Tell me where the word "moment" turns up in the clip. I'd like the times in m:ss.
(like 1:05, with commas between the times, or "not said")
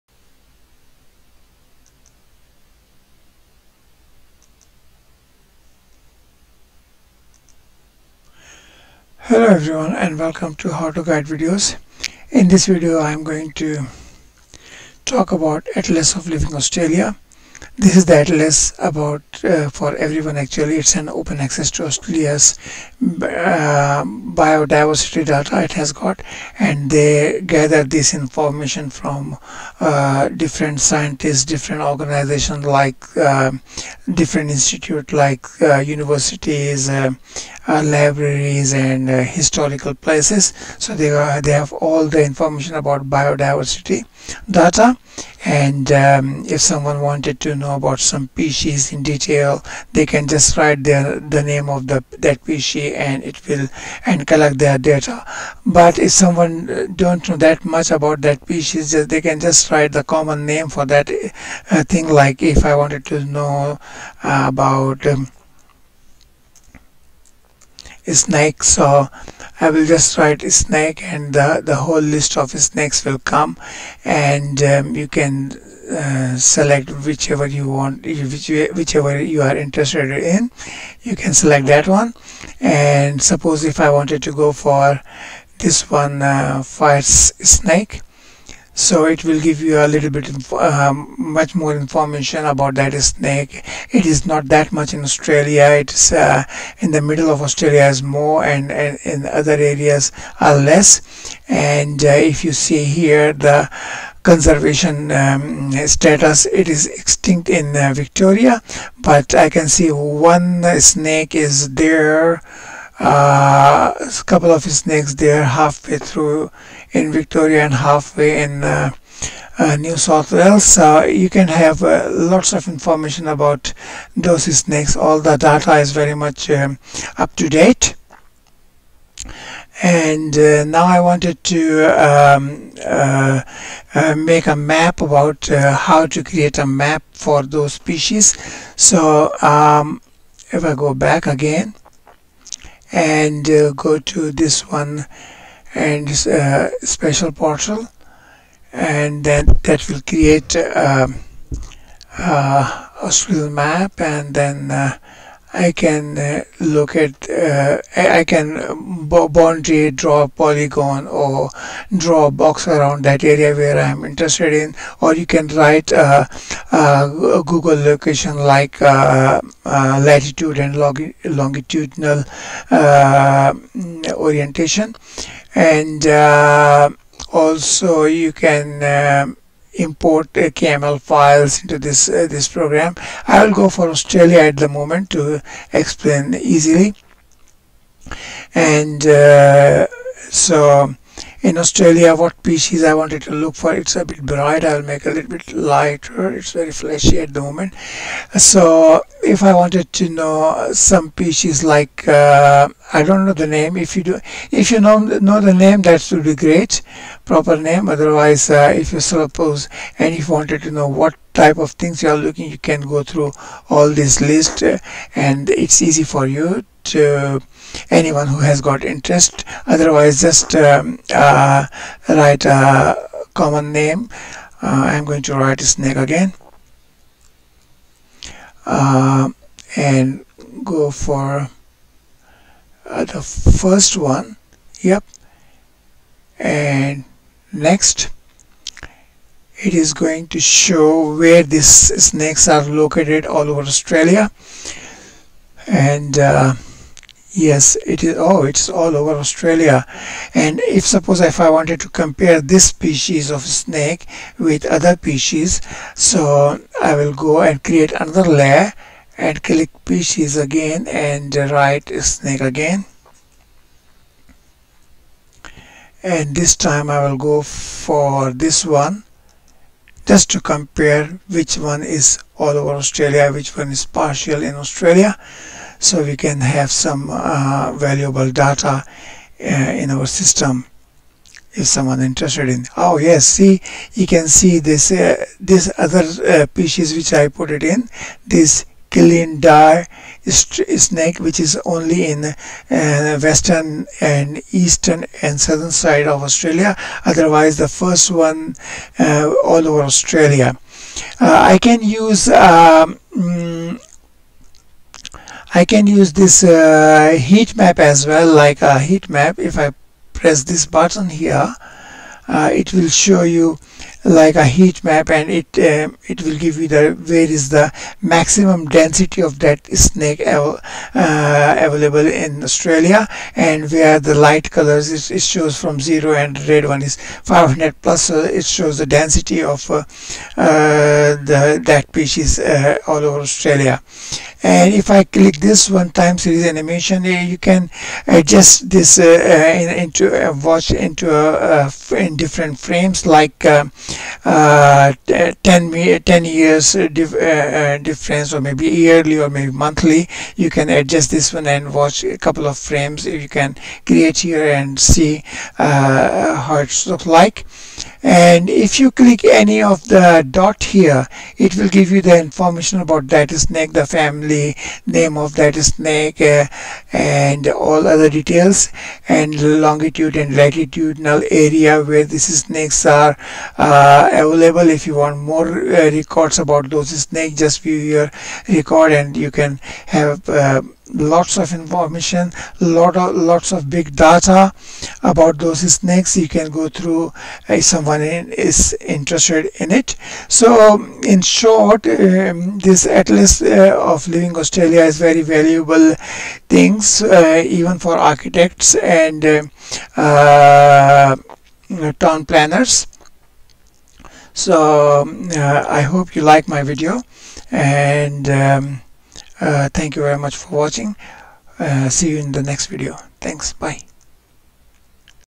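3:04, 3:17.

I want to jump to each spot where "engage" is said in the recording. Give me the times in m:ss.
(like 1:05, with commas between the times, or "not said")
not said.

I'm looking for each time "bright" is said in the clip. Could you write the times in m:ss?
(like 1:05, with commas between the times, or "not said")
3:14.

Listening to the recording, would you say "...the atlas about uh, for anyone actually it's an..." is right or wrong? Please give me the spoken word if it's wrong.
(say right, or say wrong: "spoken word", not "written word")
wrong: "everyone", not "anyone".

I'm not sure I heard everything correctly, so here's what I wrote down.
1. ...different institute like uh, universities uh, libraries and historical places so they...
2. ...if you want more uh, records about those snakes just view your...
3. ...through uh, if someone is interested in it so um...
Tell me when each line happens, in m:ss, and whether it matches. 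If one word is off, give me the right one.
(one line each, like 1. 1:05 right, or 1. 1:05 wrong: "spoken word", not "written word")
1. 0:34 right
2. 6:14 right
3. 6:26 right.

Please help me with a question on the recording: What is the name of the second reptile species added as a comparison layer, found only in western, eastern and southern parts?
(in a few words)
Killing dire snake.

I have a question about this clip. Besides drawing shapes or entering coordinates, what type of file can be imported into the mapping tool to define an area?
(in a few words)
KML files.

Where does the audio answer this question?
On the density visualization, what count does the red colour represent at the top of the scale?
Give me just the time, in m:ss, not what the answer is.
5:26.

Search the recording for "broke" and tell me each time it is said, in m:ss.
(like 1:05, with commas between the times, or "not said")
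not said.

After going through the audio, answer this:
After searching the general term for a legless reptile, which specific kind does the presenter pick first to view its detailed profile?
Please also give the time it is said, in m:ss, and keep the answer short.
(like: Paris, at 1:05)
Fire snake, at 1:26.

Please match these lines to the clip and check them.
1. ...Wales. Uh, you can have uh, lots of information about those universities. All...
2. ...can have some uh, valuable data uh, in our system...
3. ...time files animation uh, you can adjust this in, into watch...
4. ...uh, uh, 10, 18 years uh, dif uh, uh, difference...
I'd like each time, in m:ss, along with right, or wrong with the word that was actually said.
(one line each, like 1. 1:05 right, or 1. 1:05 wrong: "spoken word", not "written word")
1. 2:00 wrong: "snakes", not "universities"
2. 4:36 right
3. 5:35 wrong: "series", not "files"
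4. 5:43 wrong: "10", not "18".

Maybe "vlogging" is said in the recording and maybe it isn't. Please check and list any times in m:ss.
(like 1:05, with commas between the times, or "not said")
not said.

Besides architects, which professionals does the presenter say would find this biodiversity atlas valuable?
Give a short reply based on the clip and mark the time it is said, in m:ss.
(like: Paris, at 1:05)
Town planners, at 6:41.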